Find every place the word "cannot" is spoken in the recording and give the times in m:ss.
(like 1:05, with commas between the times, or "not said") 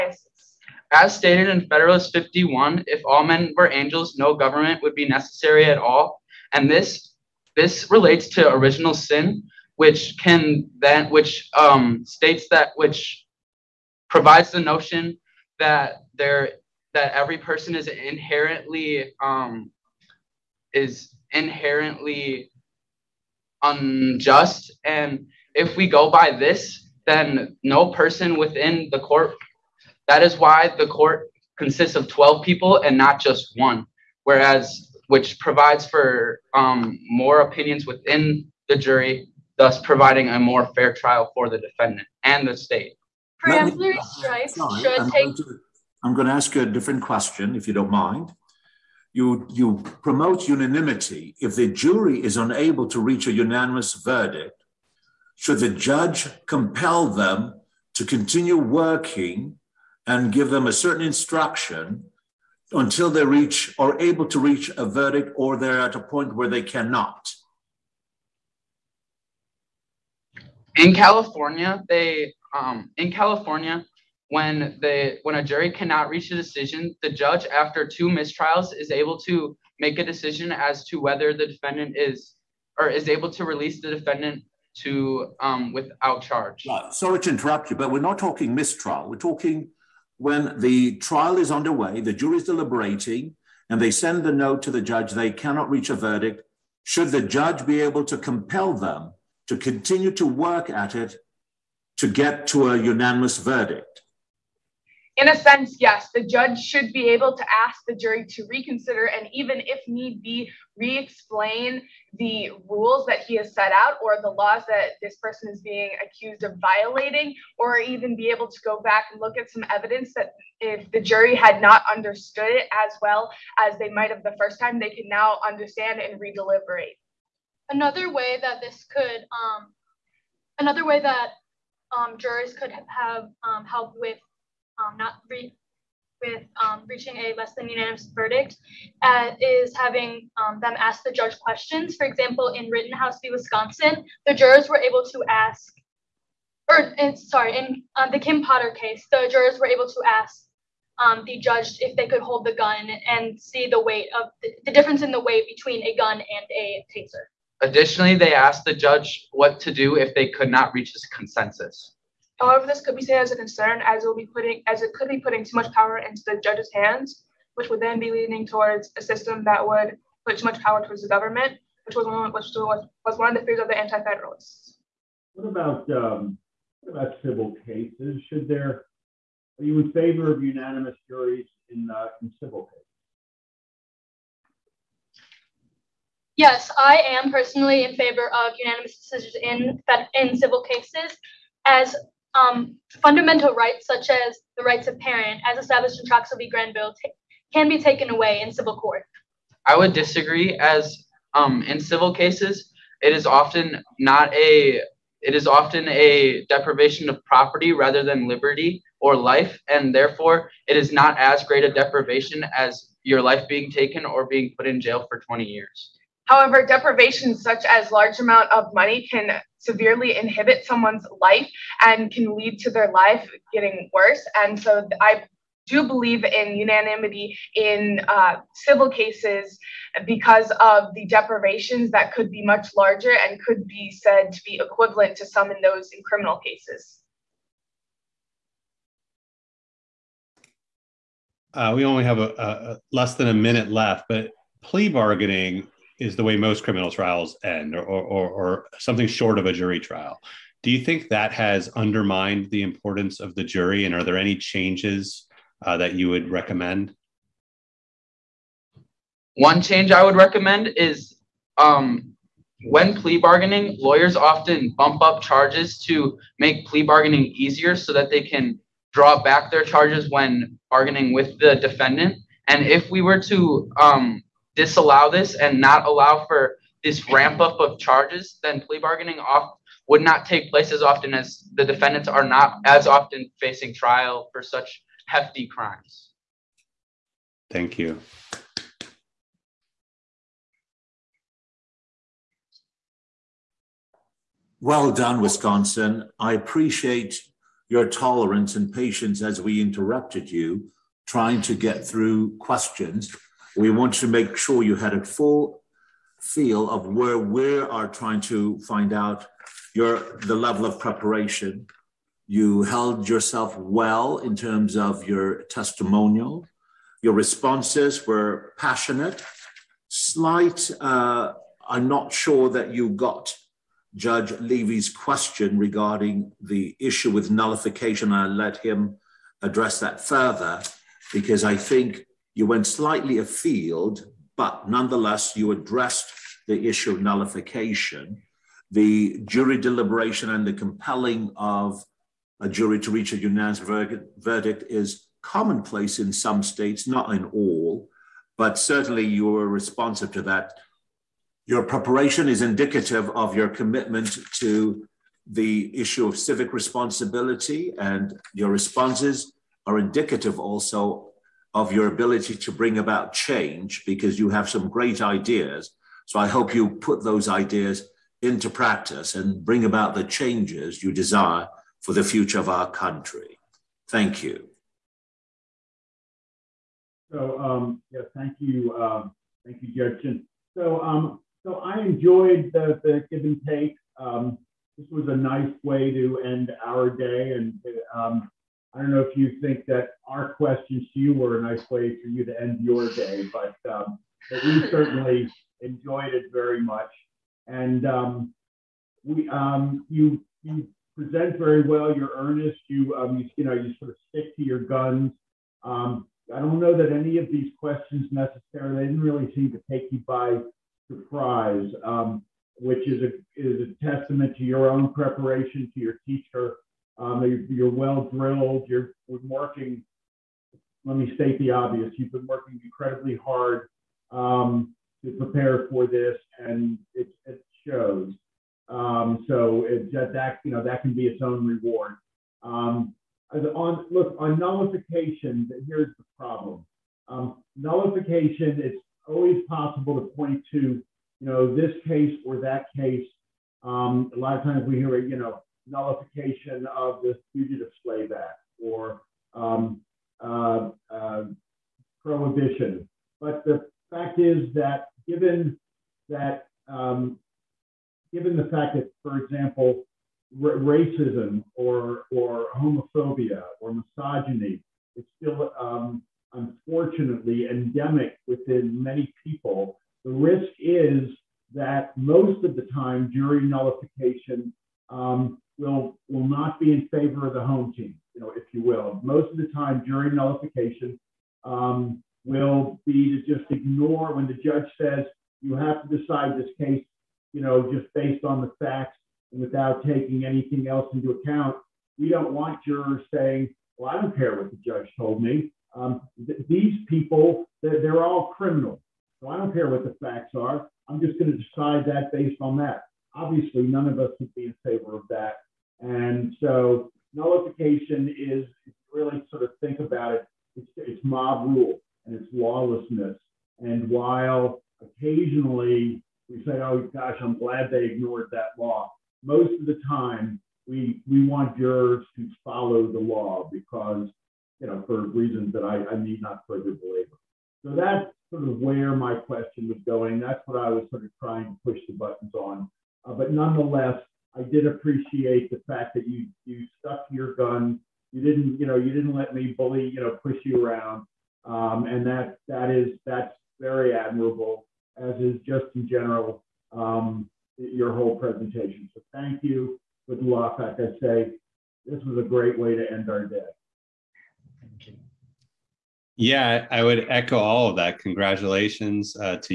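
1:06, 1:15, 1:35.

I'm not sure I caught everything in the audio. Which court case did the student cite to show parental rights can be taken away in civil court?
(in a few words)
Troxel v. Granville.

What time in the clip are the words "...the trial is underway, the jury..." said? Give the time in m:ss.
1:30.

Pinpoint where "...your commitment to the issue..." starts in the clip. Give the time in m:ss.
5:53.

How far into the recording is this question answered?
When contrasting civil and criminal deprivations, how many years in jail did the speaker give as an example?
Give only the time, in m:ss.
3:35.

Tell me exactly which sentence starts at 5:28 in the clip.
I'll let him address that further because I think you went slightly afield, but nonetheless, you addressed the issue of nullification.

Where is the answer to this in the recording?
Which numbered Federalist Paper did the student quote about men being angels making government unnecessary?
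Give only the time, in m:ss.
0:01.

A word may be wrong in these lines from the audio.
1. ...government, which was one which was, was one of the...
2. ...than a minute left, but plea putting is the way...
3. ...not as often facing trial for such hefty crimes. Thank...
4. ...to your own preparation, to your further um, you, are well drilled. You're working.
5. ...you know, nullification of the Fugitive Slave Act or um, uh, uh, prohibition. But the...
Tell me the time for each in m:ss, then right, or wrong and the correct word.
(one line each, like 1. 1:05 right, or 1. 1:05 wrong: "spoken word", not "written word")
1. 2:51 right
2. 4:03 wrong: "bargaining", not "putting"
3. 4:42 right
4. 6:54 wrong: "teacher", not "further"
5. 7:25 right.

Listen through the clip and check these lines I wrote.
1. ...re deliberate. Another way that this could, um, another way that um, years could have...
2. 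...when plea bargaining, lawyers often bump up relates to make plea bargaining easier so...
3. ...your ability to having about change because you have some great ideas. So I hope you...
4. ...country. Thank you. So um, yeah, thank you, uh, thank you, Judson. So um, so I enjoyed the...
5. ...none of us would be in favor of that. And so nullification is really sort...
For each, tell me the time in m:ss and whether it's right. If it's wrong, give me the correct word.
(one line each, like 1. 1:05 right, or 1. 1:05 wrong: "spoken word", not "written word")
1. 2:06 wrong: "jurors", not "years"
2. 4:22 wrong: "charges", not "relates"
3. 6:01 wrong: "bring", not "having"
4. 6:12 right
5. 8:23 right.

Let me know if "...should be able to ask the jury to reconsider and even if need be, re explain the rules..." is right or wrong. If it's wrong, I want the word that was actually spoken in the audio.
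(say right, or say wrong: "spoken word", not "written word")
right.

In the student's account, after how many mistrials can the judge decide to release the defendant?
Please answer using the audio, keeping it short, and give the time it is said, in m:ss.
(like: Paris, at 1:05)
2, at 1:17.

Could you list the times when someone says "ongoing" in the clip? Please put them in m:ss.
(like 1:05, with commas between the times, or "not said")
not said.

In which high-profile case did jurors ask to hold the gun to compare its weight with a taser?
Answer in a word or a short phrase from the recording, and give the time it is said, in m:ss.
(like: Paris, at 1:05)
Kim Potter case, at 2:28.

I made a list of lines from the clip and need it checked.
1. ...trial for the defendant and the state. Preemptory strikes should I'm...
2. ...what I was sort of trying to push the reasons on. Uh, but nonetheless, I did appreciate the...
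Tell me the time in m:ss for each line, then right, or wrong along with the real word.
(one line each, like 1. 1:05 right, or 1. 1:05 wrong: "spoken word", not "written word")
1. 0:40 right
2. 8:50 wrong: "buttons", not "reasons".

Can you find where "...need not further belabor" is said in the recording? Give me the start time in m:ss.
8:45.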